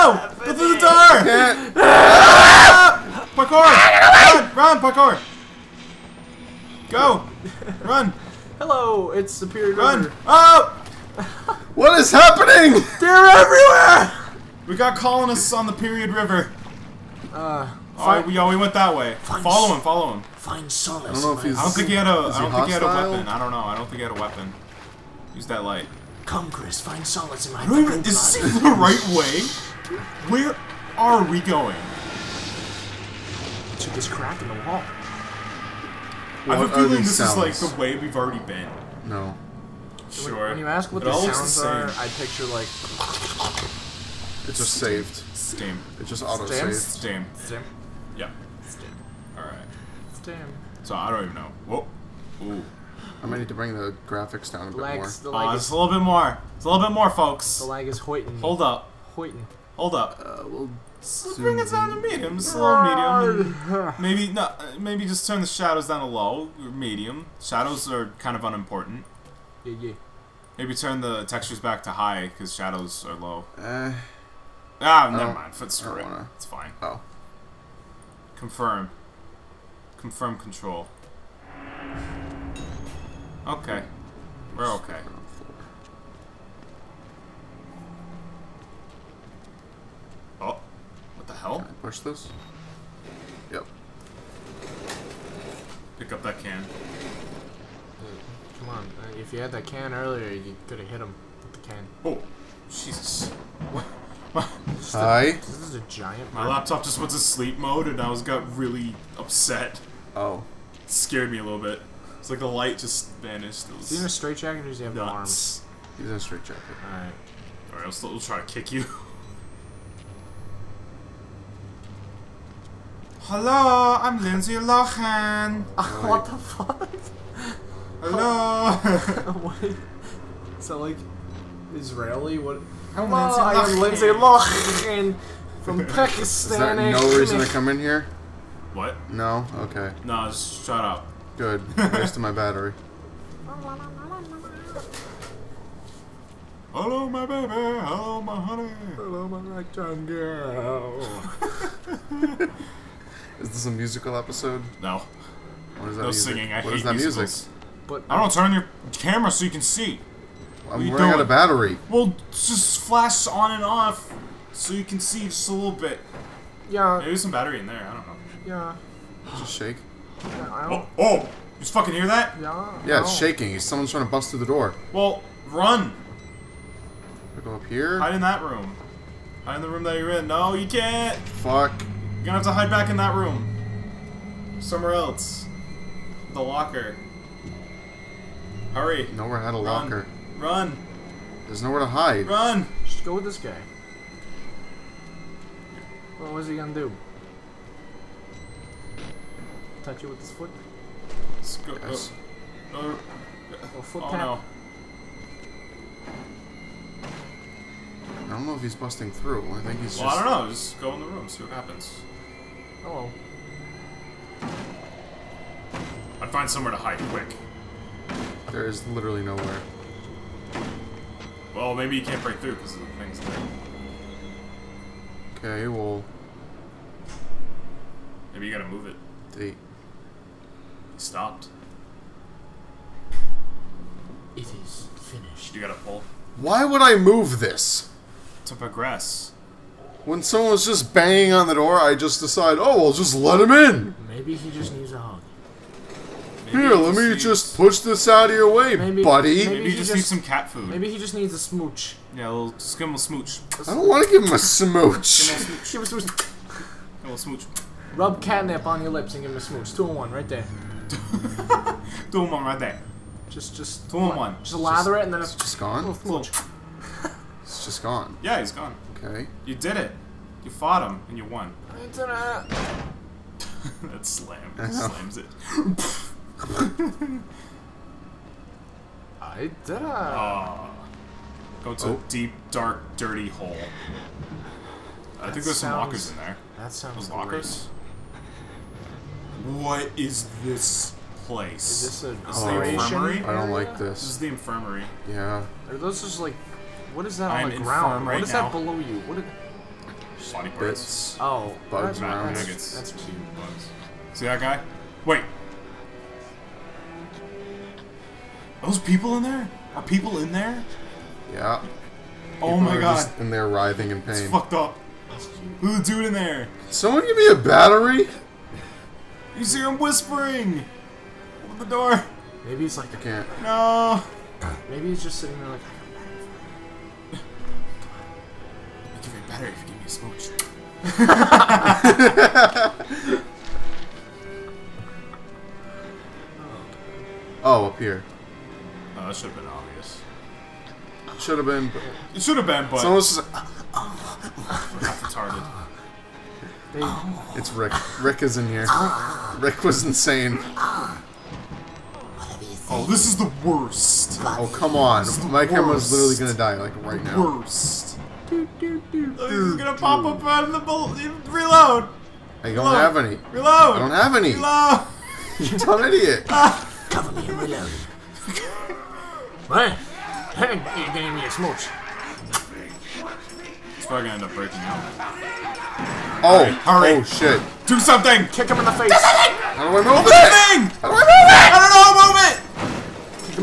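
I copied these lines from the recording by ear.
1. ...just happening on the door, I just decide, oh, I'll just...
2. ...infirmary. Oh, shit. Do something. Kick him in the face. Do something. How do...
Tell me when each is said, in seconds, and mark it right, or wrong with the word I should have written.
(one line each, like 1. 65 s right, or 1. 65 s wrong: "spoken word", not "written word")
1. 240 s wrong: "banging", not "happening"
2. 376 s wrong: "hurry", not "infirmary".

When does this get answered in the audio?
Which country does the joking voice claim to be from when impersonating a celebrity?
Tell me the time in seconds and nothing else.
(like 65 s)
135 s.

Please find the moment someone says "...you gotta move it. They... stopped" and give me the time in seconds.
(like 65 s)
228 s.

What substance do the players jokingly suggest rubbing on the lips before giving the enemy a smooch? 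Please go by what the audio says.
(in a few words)
Catnip.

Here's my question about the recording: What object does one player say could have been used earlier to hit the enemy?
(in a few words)
The can.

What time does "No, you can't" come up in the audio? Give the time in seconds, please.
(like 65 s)
180 s.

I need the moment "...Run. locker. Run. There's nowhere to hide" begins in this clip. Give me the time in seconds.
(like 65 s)
189 s.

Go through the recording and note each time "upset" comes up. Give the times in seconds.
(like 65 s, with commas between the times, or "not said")
109 s.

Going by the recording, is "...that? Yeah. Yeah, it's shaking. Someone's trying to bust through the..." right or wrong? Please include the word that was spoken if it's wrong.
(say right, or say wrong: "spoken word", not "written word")
right.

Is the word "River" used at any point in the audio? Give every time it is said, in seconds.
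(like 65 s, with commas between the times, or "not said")
10 s, 16 s.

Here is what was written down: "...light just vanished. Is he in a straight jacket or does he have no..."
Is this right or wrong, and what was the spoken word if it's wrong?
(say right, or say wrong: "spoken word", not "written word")
right.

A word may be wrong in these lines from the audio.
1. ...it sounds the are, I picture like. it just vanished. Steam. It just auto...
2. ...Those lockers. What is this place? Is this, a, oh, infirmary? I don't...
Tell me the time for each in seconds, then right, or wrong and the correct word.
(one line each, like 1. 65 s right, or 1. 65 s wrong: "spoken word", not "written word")
1. 41 s wrong: "saved", not "vanished"
2. 287 s right.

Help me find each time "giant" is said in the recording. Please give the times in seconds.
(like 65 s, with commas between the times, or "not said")
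105 s.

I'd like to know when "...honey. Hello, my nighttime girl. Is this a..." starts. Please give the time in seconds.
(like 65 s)
148 s.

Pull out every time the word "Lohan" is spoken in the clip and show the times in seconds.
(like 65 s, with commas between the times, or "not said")
124 s, 134 s.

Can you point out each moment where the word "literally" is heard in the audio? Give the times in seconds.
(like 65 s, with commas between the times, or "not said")
218 s, 355 s.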